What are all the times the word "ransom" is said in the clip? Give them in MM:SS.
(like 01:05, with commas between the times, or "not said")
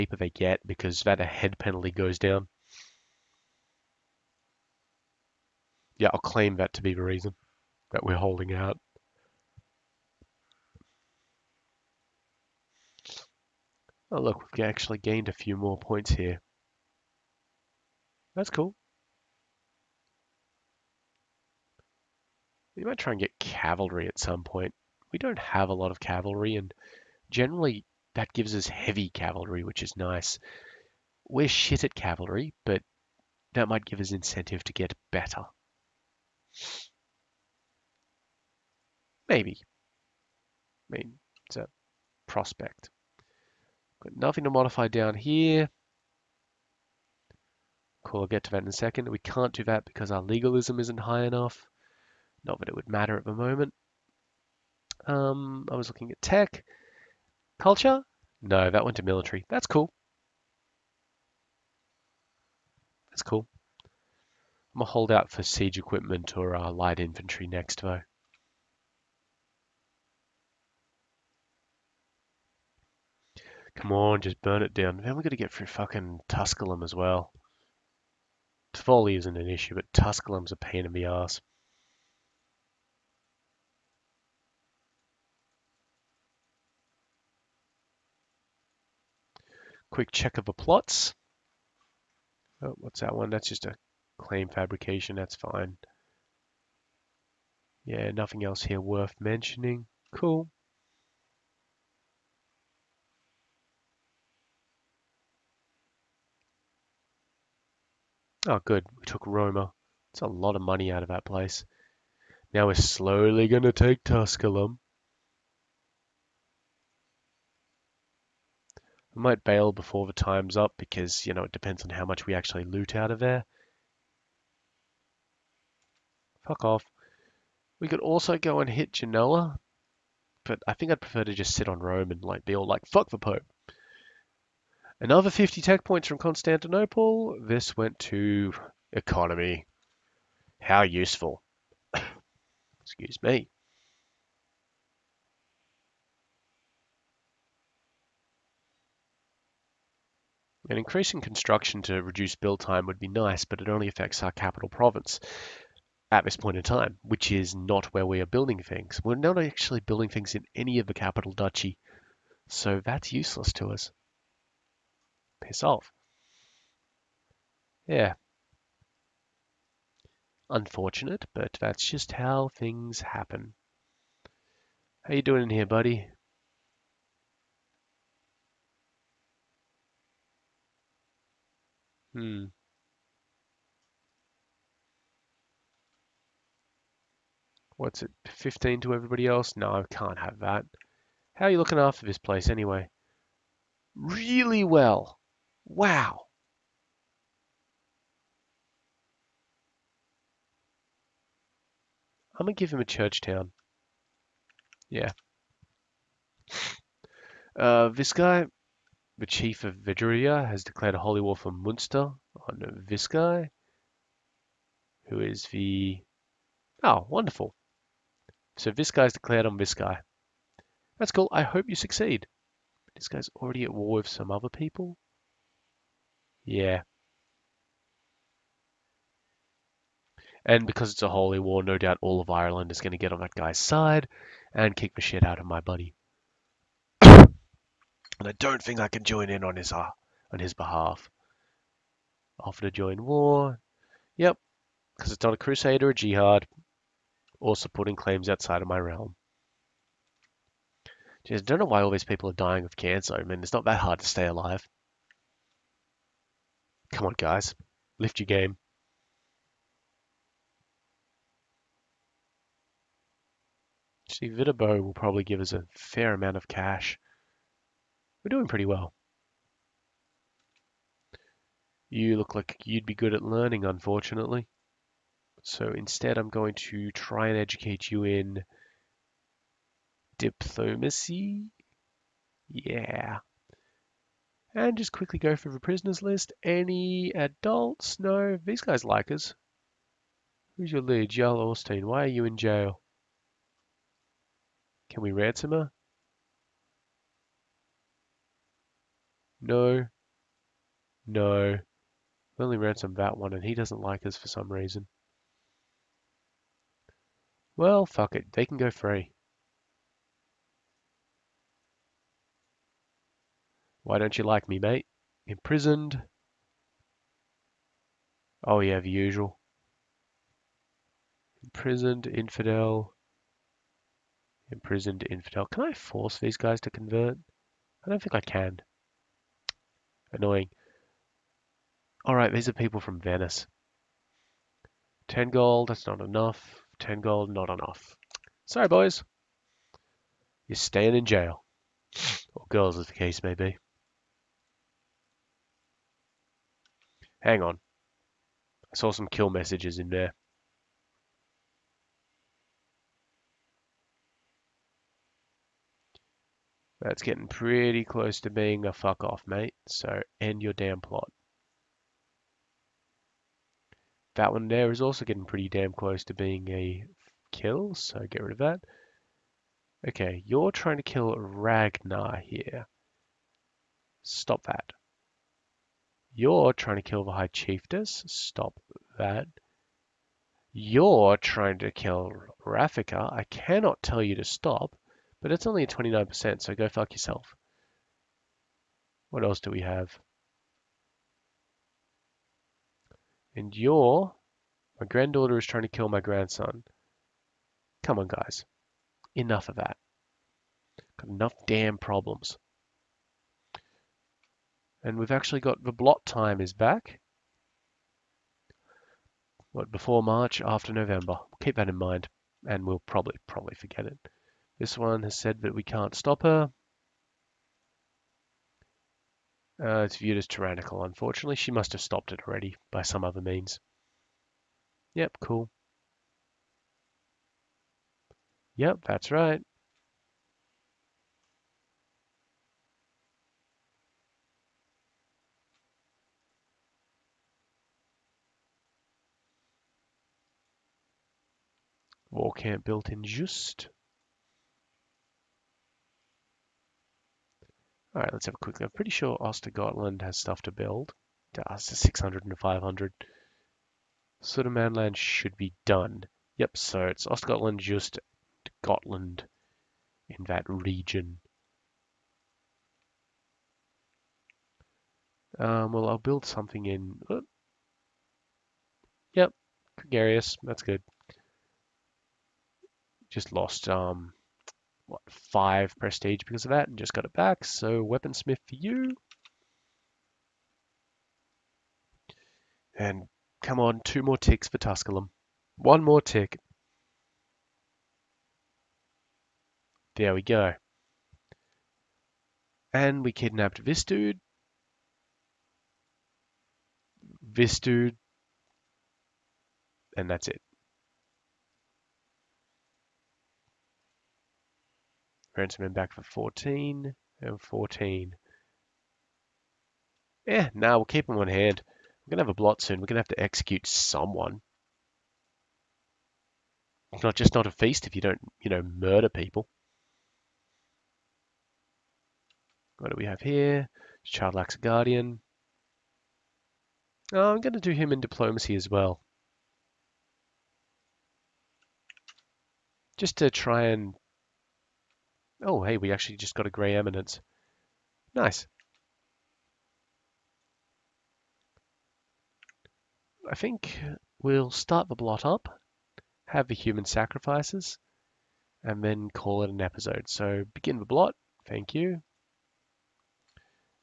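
04:55, 05:02, 08:25.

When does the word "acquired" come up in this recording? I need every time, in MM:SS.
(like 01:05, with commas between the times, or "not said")
not said.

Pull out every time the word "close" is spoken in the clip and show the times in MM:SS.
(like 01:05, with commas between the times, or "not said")
05:57, 06:05.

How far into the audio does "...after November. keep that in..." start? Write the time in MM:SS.
06:50.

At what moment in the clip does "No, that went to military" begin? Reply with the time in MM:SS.
00:58.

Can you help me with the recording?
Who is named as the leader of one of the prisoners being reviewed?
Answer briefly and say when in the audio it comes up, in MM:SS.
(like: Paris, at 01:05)
Jarl Orstein, at 04:51.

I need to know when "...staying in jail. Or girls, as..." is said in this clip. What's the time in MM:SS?
05:40.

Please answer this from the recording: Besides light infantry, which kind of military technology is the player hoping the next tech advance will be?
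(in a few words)
Siege equipment.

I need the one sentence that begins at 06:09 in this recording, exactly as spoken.
Okay, you're trying to kill Ragnar here.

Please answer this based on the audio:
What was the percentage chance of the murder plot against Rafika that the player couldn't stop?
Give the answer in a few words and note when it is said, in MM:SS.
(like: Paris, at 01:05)
29%, at 06:25.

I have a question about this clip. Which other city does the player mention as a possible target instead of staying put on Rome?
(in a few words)
Genoa.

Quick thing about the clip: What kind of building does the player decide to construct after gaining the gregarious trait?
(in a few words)
Weaponsmith.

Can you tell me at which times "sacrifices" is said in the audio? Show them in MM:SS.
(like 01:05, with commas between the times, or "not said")
09:06.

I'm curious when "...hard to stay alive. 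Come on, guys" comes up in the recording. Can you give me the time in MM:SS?
04:13.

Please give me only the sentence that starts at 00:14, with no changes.
Oh, look, we've actually gained a few more points here.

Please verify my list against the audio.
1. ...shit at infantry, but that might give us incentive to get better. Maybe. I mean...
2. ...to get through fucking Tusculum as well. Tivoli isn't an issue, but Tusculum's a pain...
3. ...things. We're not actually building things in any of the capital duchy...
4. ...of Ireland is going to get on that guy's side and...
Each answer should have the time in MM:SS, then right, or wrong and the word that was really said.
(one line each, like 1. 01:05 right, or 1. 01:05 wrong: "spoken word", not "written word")
1. 00:31 wrong: "cavalry", not "infantry"
2. 01:15 right
3. 02:38 right
4. 03:52 right.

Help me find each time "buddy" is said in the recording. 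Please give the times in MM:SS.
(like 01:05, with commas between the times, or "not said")
02:55, 03:55.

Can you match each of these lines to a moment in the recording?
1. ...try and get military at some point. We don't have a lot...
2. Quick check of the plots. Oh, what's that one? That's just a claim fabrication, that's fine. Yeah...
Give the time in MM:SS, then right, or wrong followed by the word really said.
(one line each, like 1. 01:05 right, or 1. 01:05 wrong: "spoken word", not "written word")
1. 00:22 wrong: "cavalry", not "military"
2. 01:29 right.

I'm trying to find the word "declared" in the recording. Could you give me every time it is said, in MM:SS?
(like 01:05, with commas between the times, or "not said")
03:30, 03:39.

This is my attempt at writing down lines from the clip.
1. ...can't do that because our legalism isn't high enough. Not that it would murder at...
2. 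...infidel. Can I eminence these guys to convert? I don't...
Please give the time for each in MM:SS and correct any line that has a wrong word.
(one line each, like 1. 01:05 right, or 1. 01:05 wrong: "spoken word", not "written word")
1. 00:49 wrong: "matter", not "murder"
2. 05:25 wrong: "force", not "eminence".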